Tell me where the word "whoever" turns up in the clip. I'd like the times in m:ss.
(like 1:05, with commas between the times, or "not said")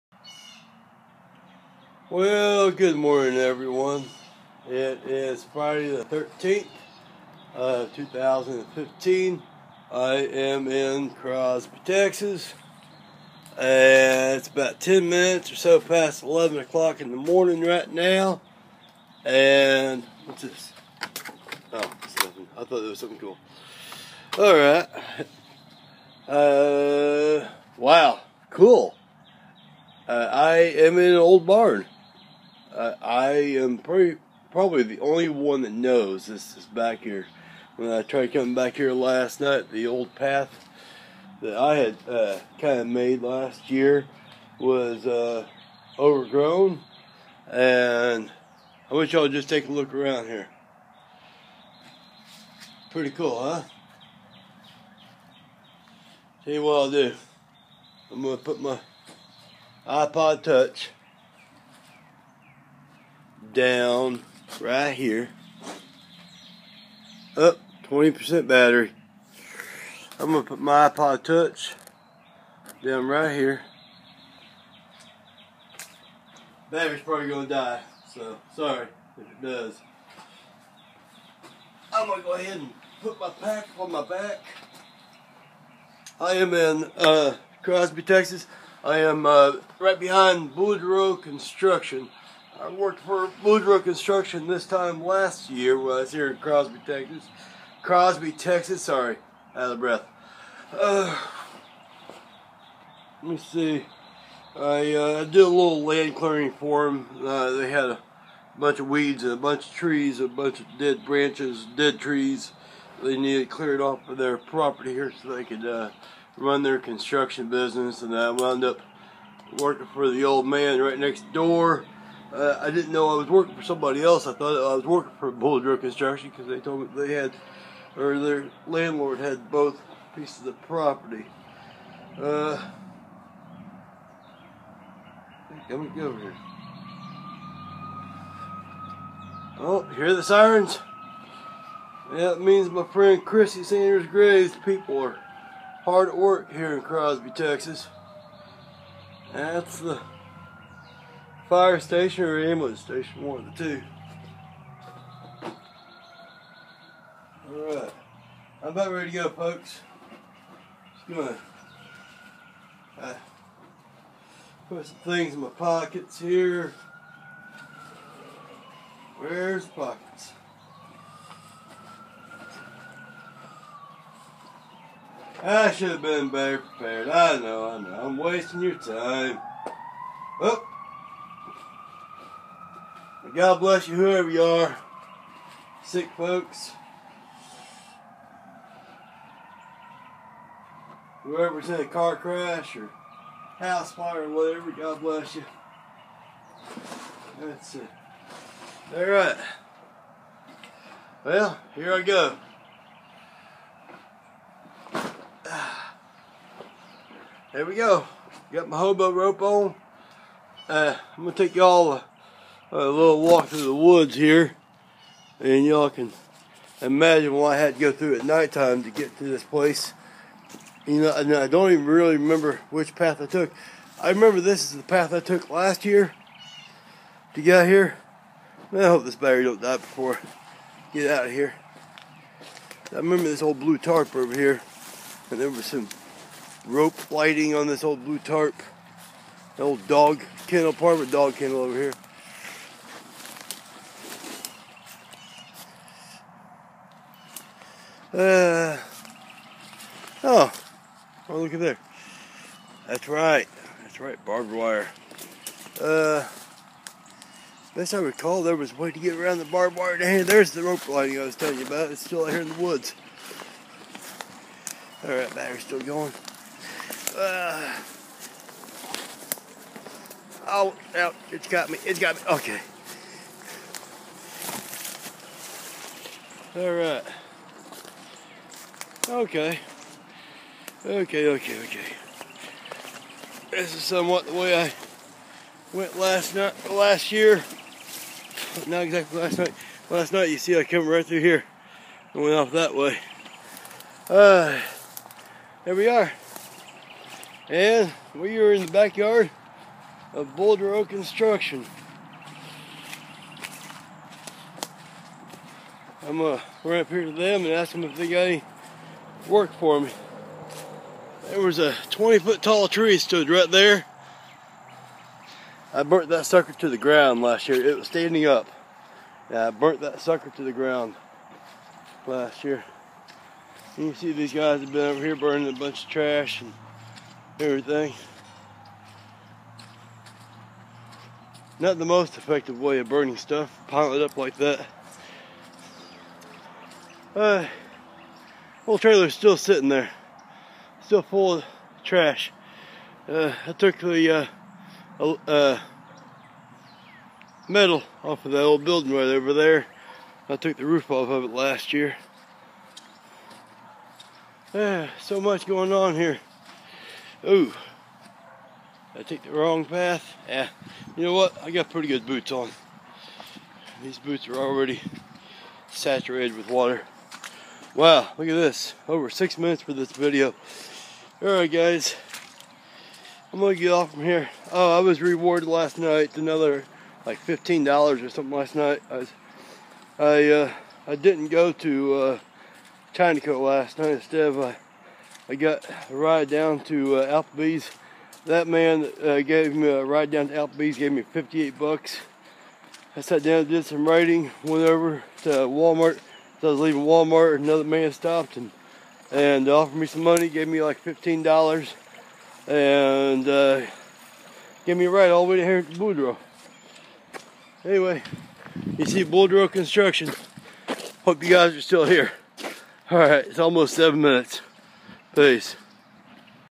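3:03, 3:11.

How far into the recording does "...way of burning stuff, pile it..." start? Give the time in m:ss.
5:32.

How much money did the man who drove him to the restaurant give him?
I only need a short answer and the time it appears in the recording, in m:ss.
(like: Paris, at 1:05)
$58, at 6:31.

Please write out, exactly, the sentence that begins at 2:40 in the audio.
Just gonna uh, put some things in my pockets here.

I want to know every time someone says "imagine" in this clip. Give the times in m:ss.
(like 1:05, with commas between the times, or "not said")
3:36.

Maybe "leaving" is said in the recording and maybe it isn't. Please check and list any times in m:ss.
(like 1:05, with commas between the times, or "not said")
6:36.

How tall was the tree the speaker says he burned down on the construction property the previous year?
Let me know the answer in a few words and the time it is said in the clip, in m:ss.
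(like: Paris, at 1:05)
20 feet, at 5:11.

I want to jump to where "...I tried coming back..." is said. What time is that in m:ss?
0:37.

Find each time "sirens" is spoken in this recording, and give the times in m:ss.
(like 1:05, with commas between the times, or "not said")
2:20.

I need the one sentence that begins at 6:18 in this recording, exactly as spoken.
I, was, I, uh, I didn't go to uh, Chinaco last night.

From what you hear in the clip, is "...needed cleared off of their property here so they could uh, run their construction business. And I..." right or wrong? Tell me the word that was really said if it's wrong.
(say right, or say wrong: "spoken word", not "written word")
right.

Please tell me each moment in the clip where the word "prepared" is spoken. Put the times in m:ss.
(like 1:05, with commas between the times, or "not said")
2:56.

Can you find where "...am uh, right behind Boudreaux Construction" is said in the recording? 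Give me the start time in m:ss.
1:28.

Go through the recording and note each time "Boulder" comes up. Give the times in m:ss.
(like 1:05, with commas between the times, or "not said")
2:05, 5:00.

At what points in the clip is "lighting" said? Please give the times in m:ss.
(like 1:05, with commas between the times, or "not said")
3:57, 4:20.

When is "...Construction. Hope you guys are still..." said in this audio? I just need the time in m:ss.
6:49.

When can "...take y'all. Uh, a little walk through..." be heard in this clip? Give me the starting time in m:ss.
3:31.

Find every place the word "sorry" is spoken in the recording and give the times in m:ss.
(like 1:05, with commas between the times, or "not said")
1:18, 1:38.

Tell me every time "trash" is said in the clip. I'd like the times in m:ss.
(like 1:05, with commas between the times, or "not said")
5:25, 5:41.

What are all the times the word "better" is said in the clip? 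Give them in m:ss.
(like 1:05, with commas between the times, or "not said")
2:56.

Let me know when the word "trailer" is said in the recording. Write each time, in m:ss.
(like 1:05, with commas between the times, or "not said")
5:38.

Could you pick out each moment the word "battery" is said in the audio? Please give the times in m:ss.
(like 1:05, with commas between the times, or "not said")
1:08, 1:16, 3:49, 4:25.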